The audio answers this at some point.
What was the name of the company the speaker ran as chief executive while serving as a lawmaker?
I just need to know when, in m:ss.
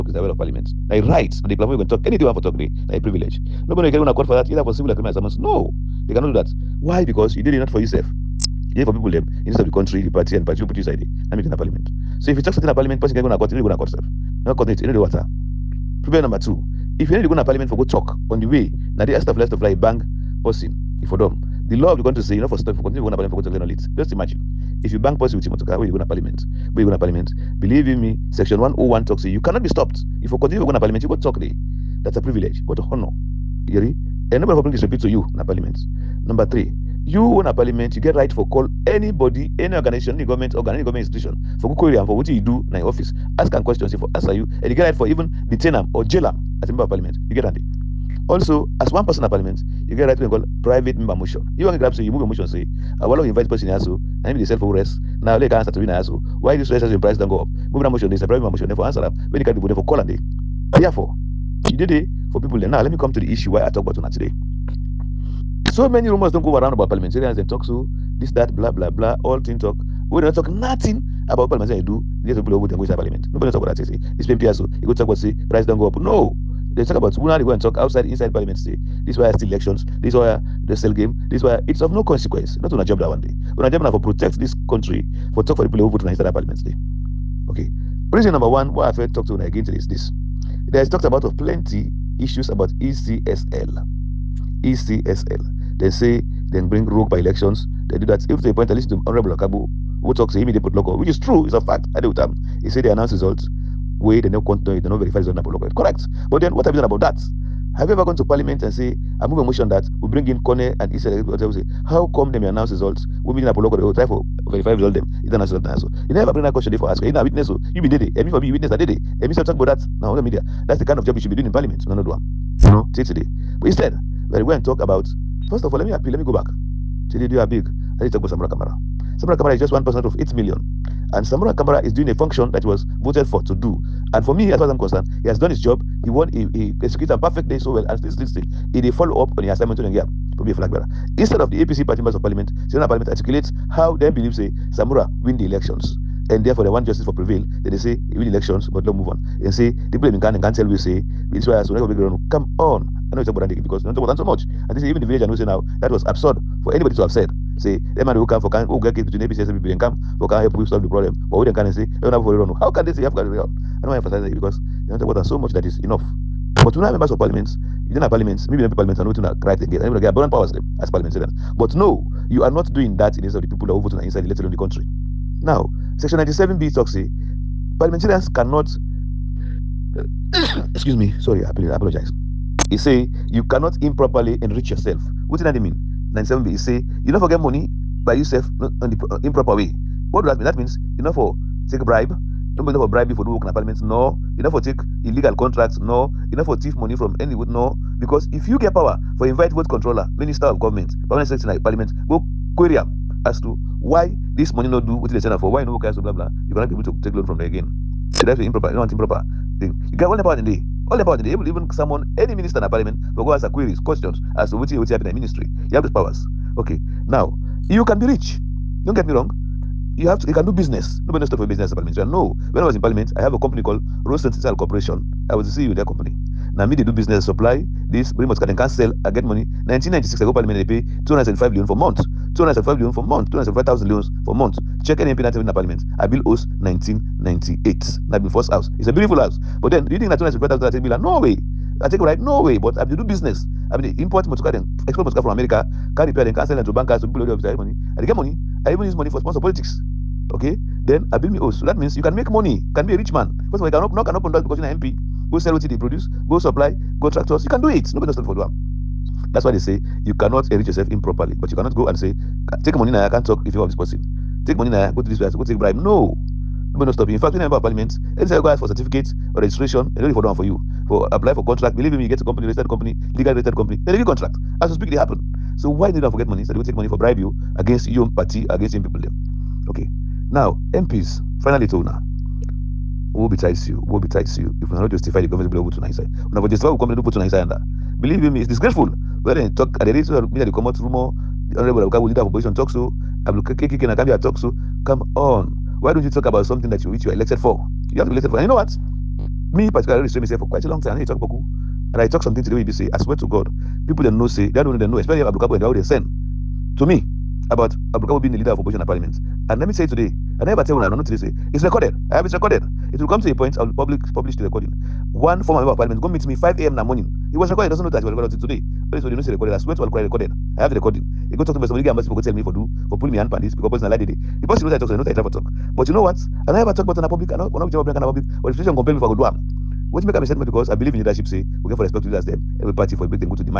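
3:44.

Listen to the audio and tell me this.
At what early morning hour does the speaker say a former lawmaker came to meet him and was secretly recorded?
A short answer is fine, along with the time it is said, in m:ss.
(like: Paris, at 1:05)
5 a.m., at 5:16.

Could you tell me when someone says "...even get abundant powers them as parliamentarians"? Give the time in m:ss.
2:49.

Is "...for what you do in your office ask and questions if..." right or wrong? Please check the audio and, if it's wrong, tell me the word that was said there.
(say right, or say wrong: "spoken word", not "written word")
right.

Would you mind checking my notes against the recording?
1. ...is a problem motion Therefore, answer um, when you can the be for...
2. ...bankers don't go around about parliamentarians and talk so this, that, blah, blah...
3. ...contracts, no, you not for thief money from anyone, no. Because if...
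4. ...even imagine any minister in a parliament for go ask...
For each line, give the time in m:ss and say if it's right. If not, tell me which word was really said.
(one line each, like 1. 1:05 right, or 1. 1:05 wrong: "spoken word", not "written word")
1. 0:58 right
2. 1:06 wrong: "rumors", not "bankers"
3. 3:15 right
4. 3:31 wrong: "someone", not "imagine".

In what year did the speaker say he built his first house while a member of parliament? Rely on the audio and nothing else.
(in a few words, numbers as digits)
1998.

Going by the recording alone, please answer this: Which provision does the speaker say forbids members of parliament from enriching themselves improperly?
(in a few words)
Section 97B.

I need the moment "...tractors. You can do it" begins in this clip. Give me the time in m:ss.
4:17.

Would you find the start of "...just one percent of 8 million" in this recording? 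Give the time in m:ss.
2:09.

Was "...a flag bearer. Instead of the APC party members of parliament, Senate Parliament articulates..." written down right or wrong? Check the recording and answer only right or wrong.
right.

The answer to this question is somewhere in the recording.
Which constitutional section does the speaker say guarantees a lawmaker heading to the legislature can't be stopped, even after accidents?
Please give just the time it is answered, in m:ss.
0:28.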